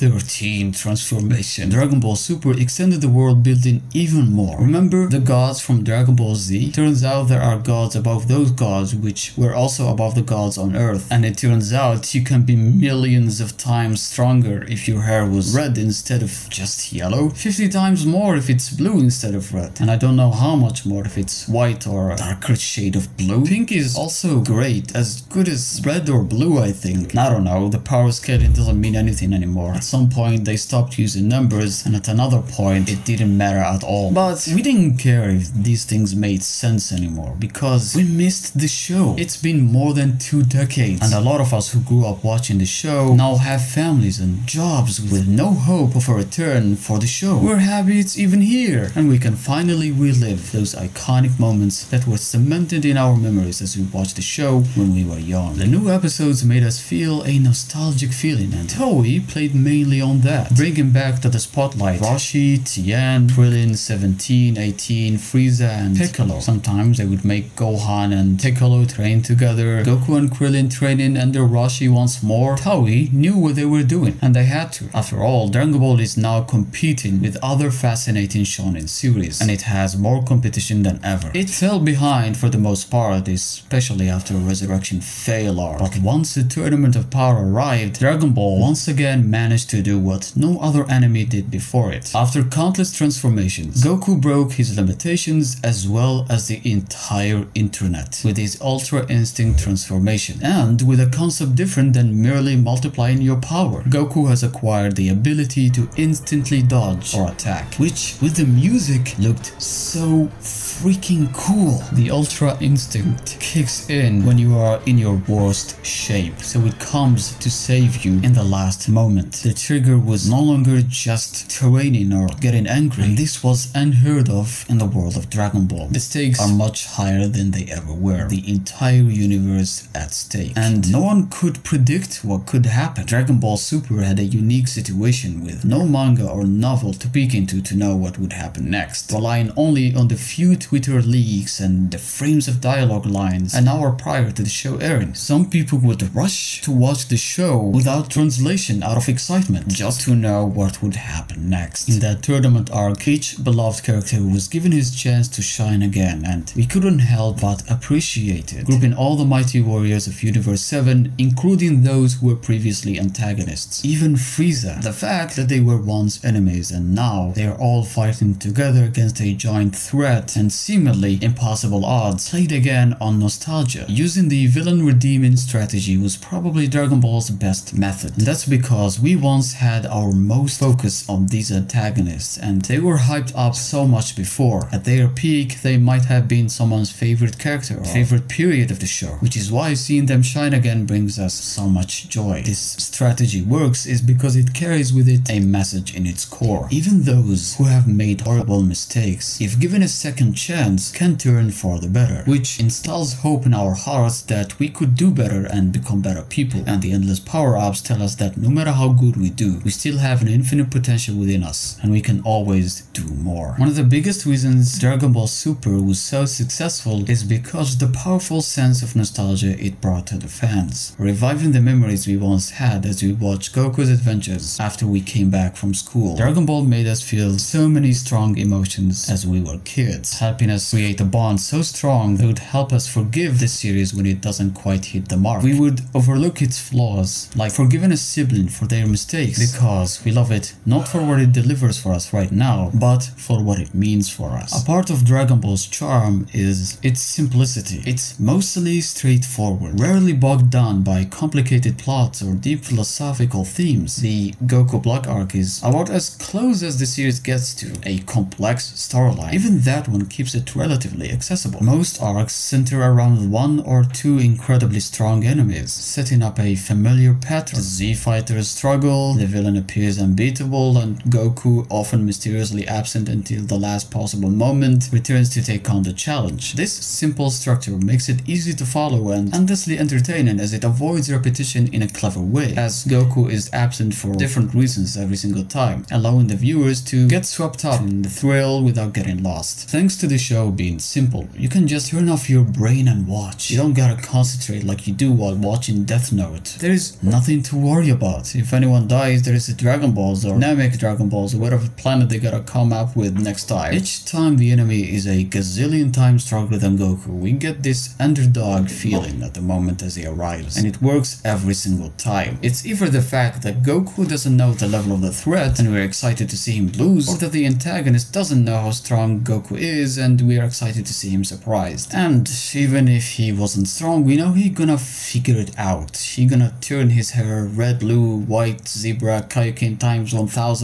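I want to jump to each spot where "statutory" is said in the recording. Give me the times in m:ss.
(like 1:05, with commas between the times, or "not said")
not said.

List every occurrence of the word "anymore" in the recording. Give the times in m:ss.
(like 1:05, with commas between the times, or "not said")
0:29, 0:36.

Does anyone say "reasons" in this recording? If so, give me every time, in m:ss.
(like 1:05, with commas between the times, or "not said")
3:34, 4:44.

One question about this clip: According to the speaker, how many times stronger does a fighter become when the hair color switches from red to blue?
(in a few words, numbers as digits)
50.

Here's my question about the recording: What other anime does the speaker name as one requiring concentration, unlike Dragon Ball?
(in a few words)
Death Note.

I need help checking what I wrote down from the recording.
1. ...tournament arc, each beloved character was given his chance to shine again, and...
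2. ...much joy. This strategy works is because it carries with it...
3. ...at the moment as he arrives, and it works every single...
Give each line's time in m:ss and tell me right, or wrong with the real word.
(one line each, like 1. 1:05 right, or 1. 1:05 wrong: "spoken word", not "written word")
1. 2:32 right
2. 3:11 right
3. 5:09 right.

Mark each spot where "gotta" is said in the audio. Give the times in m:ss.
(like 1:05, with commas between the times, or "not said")
4:53, 5:02.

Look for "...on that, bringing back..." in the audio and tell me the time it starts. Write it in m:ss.
1:00.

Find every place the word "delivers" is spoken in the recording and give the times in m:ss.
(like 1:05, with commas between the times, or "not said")
4:01.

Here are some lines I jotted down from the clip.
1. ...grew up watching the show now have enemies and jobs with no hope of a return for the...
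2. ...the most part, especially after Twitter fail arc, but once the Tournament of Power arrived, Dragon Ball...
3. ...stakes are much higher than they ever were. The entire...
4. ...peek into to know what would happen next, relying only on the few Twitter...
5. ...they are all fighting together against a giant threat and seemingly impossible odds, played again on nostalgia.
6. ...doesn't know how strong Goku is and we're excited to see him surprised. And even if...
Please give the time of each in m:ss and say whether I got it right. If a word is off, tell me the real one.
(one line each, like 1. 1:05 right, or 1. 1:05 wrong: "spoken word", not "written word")
1. 0:41 wrong: "families", not "enemies"
2. 1:22 wrong: "Resurrection", not "Twitter"
3. 2:06 right
4. 2:17 right
5. 2:47 right
6. 5:18 right.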